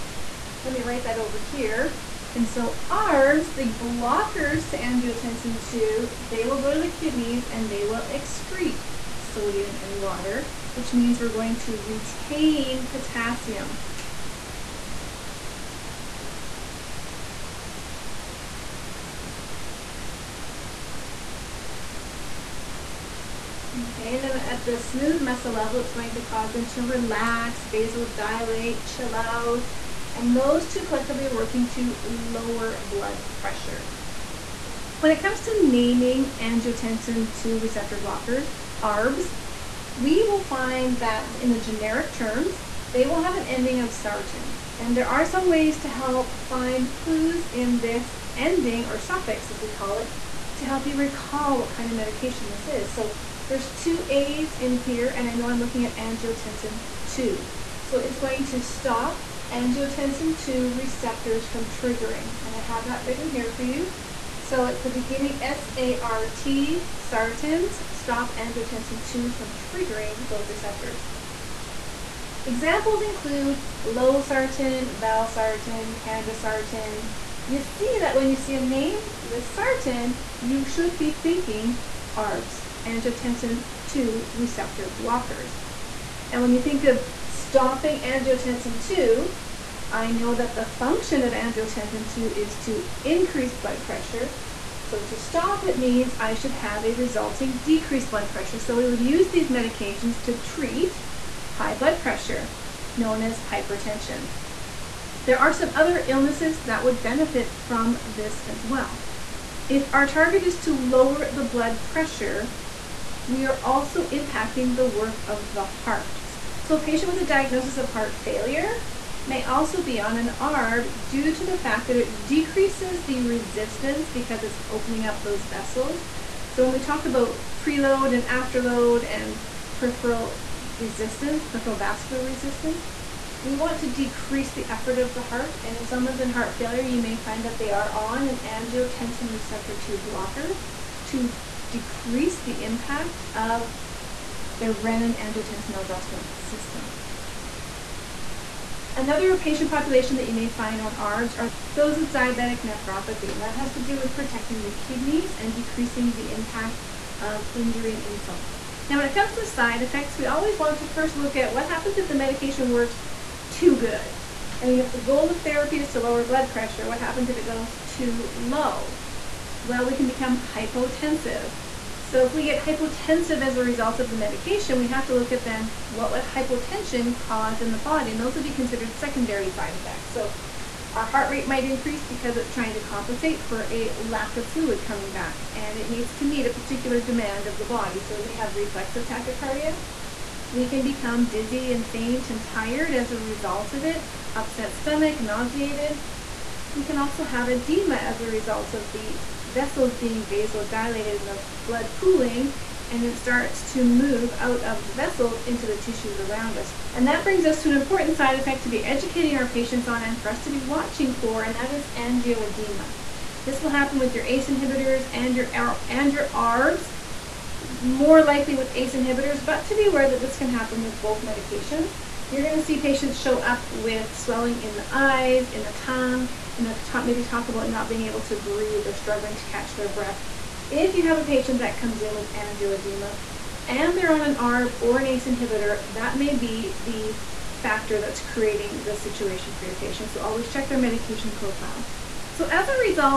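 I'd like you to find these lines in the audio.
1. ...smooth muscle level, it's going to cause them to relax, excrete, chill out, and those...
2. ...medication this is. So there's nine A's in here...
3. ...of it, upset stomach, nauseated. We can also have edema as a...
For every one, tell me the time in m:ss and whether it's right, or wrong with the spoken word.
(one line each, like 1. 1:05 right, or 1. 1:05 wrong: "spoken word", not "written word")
1. 0:24 wrong: "vasodilate", not "excrete"
2. 0:51 wrong: "two", not "nine"
3. 3:13 right.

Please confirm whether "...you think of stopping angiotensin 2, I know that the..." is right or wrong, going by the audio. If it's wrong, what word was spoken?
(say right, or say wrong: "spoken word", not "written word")
right.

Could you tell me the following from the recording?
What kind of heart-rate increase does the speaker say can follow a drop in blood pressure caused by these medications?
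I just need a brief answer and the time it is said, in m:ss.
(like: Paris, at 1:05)
Reflexive tachycardia, at 3:08.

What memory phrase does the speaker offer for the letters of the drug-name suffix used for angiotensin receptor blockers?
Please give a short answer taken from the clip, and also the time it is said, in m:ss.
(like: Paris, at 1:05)
Stop angiotensin 2 from triggering, at 1:07.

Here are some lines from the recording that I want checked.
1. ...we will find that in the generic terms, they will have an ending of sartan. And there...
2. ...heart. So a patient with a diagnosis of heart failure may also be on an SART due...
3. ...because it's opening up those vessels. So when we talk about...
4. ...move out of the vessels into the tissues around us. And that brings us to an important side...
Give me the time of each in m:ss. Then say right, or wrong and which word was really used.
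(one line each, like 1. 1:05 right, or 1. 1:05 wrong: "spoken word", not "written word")
1. 0:39 right
2. 1:55 wrong: "ARB", not "SART"
3. 2:04 right
4. 3:23 right.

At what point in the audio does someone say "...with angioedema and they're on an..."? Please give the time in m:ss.
3:52.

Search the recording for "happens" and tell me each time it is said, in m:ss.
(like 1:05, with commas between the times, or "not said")
2:41, 2:46, 3:33, 3:40.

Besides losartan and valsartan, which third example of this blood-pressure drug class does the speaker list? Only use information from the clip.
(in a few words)
Candesartan.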